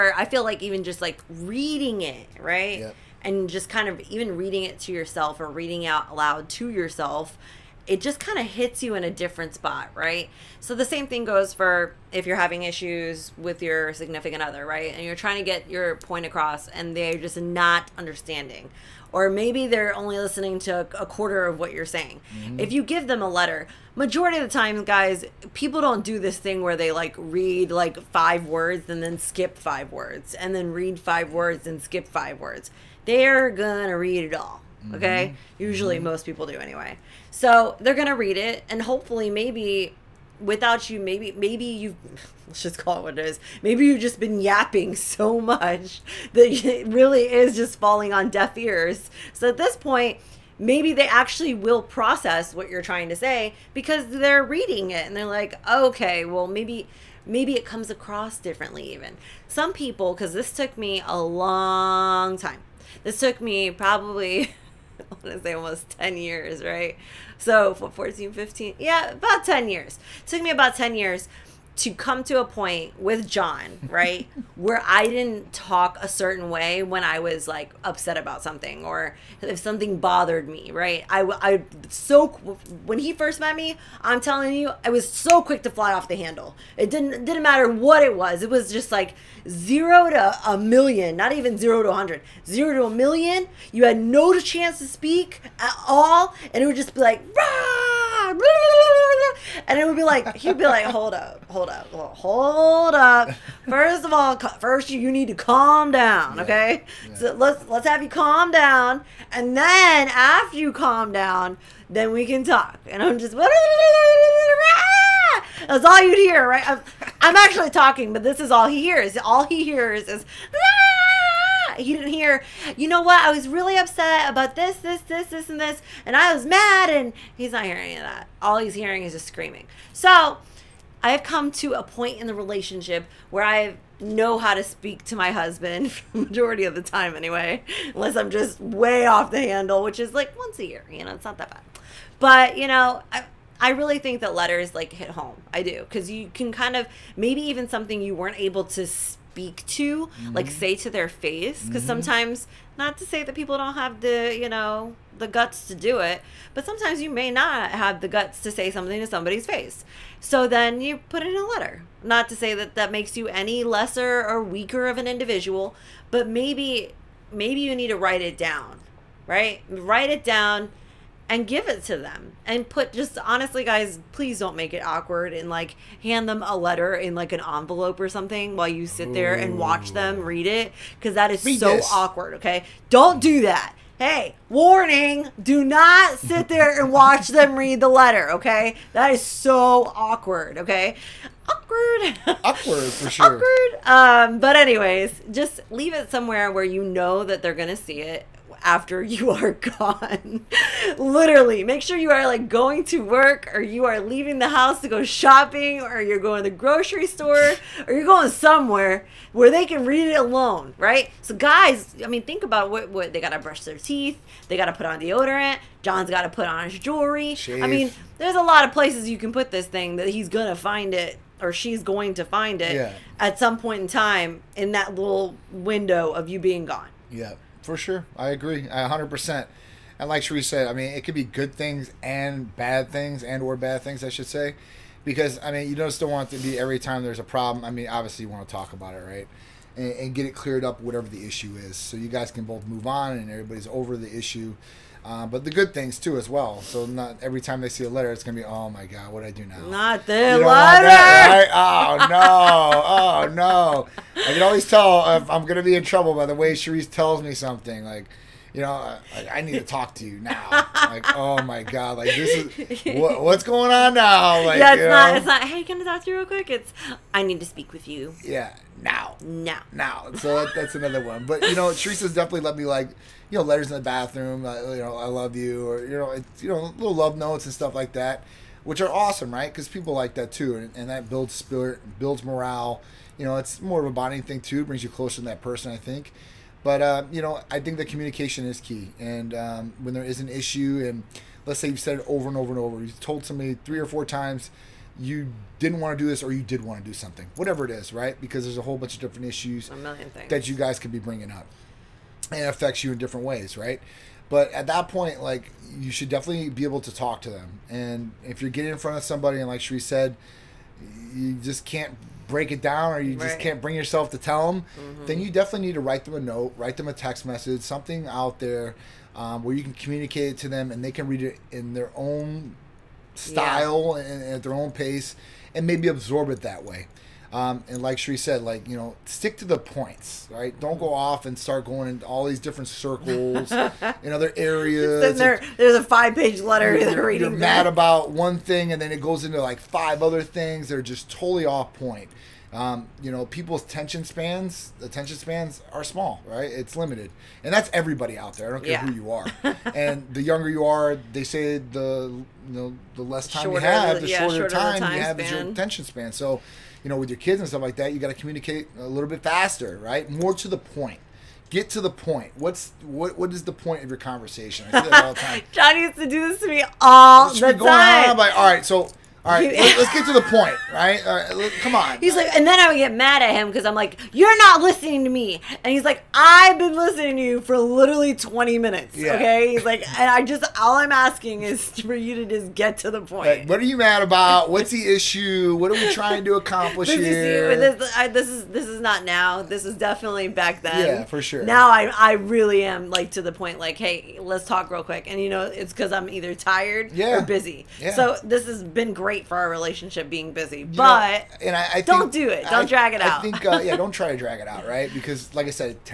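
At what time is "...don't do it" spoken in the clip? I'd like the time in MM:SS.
06:41.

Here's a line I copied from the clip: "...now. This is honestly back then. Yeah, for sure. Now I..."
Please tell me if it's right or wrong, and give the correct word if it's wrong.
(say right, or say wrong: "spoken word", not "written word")
wrong: "definitely", not "honestly".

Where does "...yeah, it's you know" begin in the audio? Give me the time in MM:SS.
04:24.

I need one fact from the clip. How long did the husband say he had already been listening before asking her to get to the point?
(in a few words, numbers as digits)
20 minutes.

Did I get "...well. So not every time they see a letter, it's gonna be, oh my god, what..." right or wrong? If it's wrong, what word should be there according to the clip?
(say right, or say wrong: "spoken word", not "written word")
right.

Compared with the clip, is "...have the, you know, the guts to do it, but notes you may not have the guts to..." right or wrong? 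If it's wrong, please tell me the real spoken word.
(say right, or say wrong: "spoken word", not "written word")
wrong: "sometimes", not "notes".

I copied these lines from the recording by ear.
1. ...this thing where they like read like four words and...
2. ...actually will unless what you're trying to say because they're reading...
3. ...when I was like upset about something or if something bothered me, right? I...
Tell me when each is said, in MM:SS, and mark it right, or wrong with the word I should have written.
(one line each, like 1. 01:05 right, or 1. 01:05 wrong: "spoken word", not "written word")
1. 00:26 wrong: "five", not "four"
2. 00:51 wrong: "process", not "unless"
3. 01:16 right.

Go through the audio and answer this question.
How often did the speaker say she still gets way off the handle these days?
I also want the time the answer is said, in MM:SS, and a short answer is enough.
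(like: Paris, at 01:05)
once a year, at 02:20.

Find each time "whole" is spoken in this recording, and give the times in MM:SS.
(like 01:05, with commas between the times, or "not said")
04:58.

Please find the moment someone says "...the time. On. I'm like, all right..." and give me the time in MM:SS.
06:07.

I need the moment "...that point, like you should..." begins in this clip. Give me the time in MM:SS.
05:04.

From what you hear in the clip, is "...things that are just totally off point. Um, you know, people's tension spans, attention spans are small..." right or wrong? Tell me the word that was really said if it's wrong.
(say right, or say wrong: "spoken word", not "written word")
right.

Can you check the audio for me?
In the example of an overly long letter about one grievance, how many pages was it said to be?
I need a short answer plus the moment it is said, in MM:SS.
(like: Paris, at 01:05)
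5, at 05:35.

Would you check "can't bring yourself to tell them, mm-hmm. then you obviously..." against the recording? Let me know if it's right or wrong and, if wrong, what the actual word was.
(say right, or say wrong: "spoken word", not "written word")
wrong: "definitely", not "obviously".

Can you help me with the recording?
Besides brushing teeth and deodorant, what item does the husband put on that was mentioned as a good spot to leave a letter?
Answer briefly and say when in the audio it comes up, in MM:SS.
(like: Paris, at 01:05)
his jewelry, at 03:36.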